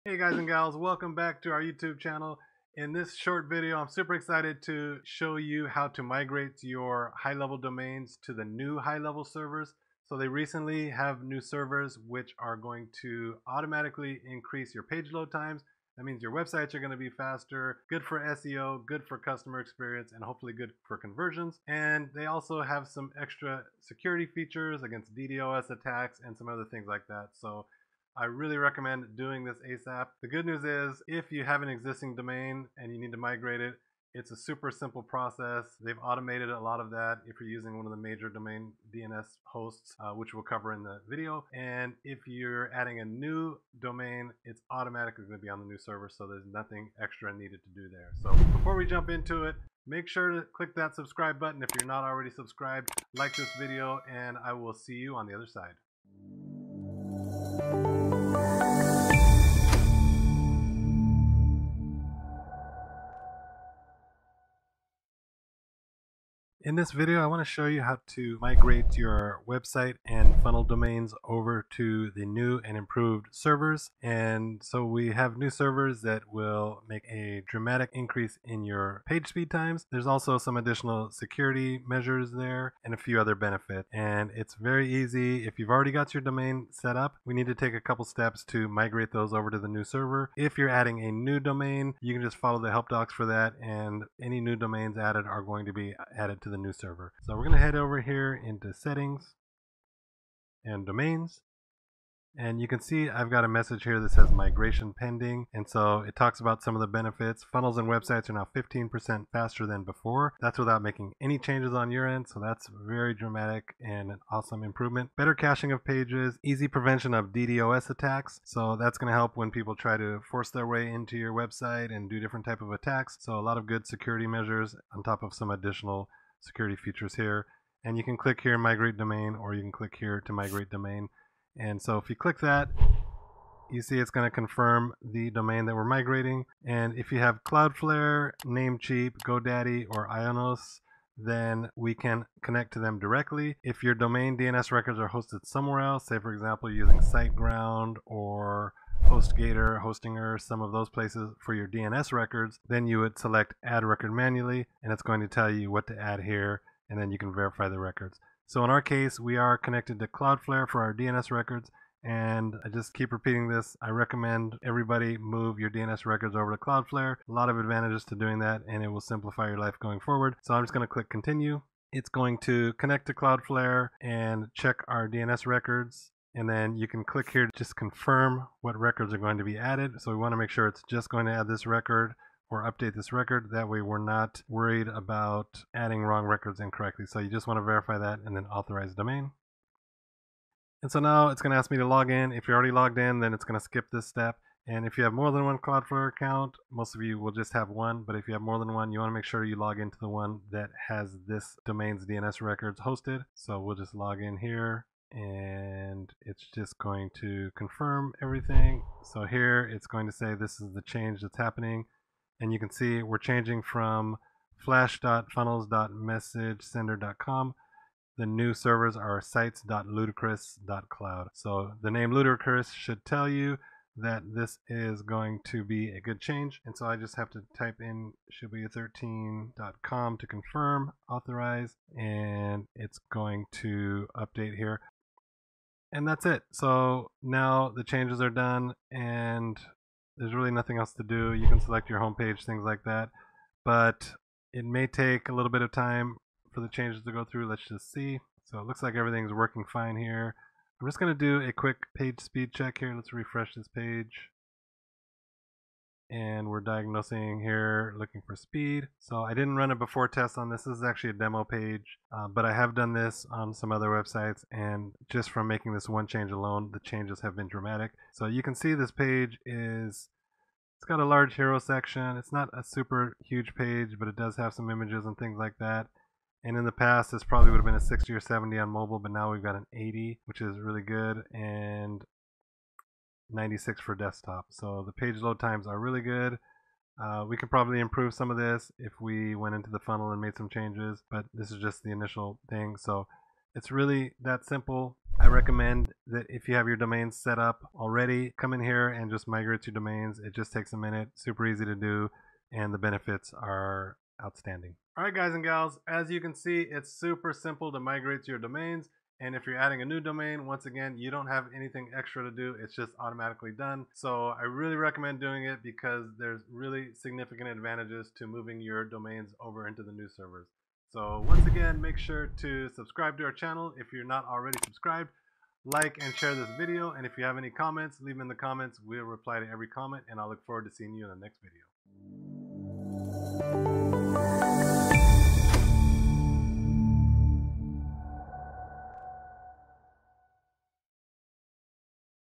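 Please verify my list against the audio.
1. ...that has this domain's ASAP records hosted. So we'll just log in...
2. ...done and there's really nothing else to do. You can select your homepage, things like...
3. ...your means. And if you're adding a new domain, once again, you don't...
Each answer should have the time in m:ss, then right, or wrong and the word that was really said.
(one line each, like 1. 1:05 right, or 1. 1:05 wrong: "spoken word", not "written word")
1. 3:20 wrong: "DNS", not "ASAP"
2. 3:58 right
3. 5:08 wrong: "domains", not "means".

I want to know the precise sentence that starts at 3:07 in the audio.
So you just want to verify that and then authorize domain.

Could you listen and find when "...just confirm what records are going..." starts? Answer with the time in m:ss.
2:57.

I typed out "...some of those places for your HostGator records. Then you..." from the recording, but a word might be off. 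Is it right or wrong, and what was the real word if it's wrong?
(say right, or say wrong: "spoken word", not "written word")
wrong: "DNS", not "HostGator".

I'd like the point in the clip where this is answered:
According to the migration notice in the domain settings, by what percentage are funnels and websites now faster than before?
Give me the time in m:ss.
1:48.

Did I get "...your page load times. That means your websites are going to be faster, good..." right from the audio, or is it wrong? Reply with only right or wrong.
right.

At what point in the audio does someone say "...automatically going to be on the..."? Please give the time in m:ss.
0:44.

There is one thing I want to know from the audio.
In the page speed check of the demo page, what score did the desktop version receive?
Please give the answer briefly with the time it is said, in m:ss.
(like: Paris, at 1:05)
96, at 4:43.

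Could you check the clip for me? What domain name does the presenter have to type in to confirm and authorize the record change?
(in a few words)
shibuya13.com.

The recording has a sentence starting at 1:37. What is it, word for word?
So we're going to head over here into settings and domains.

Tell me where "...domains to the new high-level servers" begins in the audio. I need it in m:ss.
0:07.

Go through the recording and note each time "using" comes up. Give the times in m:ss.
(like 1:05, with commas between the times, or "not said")
0:37, 2:26.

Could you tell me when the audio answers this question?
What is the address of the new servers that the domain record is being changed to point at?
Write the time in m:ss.
3:39.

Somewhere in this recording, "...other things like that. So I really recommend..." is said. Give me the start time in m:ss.
0:26.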